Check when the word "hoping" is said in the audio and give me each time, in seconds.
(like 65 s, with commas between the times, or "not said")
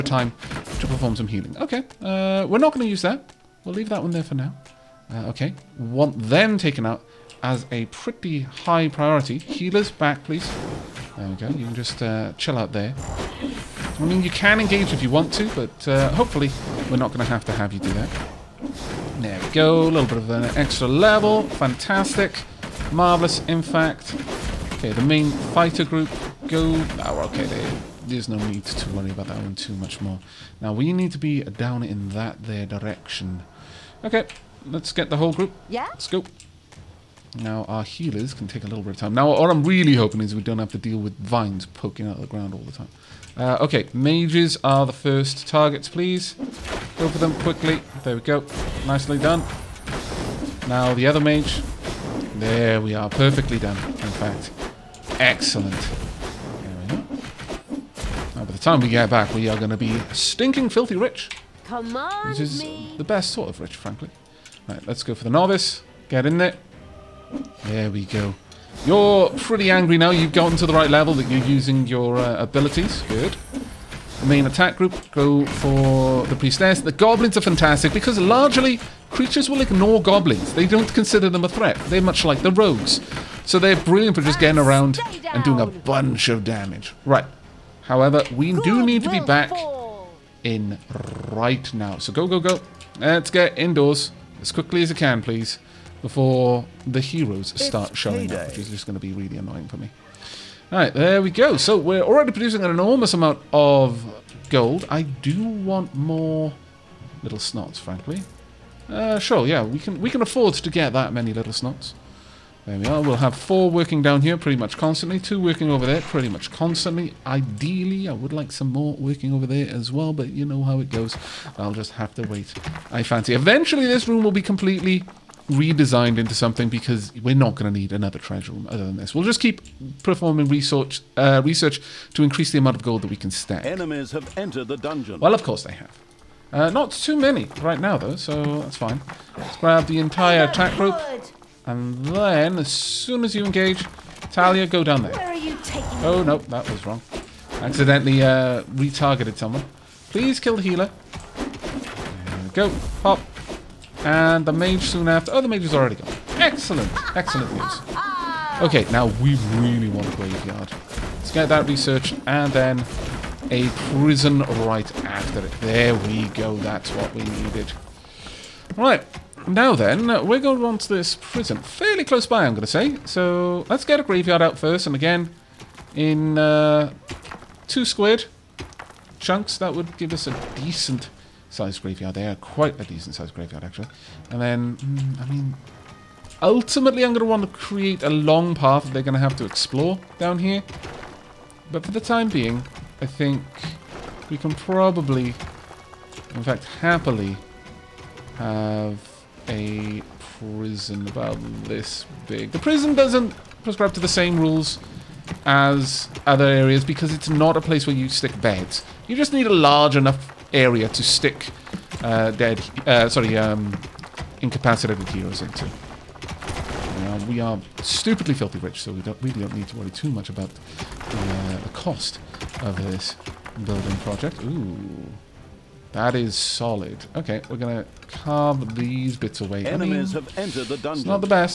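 39 s.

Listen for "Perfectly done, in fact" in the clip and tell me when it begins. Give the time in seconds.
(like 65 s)
53 s.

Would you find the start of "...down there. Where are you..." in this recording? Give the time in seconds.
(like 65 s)
144 s.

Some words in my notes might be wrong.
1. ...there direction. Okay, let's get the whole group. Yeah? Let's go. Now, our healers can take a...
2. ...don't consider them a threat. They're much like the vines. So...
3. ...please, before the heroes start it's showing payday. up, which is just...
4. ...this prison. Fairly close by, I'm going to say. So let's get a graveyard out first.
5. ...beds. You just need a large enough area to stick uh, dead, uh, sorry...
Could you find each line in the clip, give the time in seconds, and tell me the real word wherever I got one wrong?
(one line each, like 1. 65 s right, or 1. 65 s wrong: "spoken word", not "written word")
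1. 32 s right
2. 80 s wrong: "rogues", not "vines"
3. 95 s right
4. 170 s right
5. 208 s right.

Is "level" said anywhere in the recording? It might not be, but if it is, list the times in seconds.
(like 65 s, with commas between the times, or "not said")
20 s, 70 s.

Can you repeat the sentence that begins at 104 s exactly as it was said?
I do want more little snots, frankly.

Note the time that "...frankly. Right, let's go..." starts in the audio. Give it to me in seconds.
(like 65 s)
63 s.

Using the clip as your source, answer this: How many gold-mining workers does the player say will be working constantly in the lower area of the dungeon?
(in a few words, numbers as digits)
4.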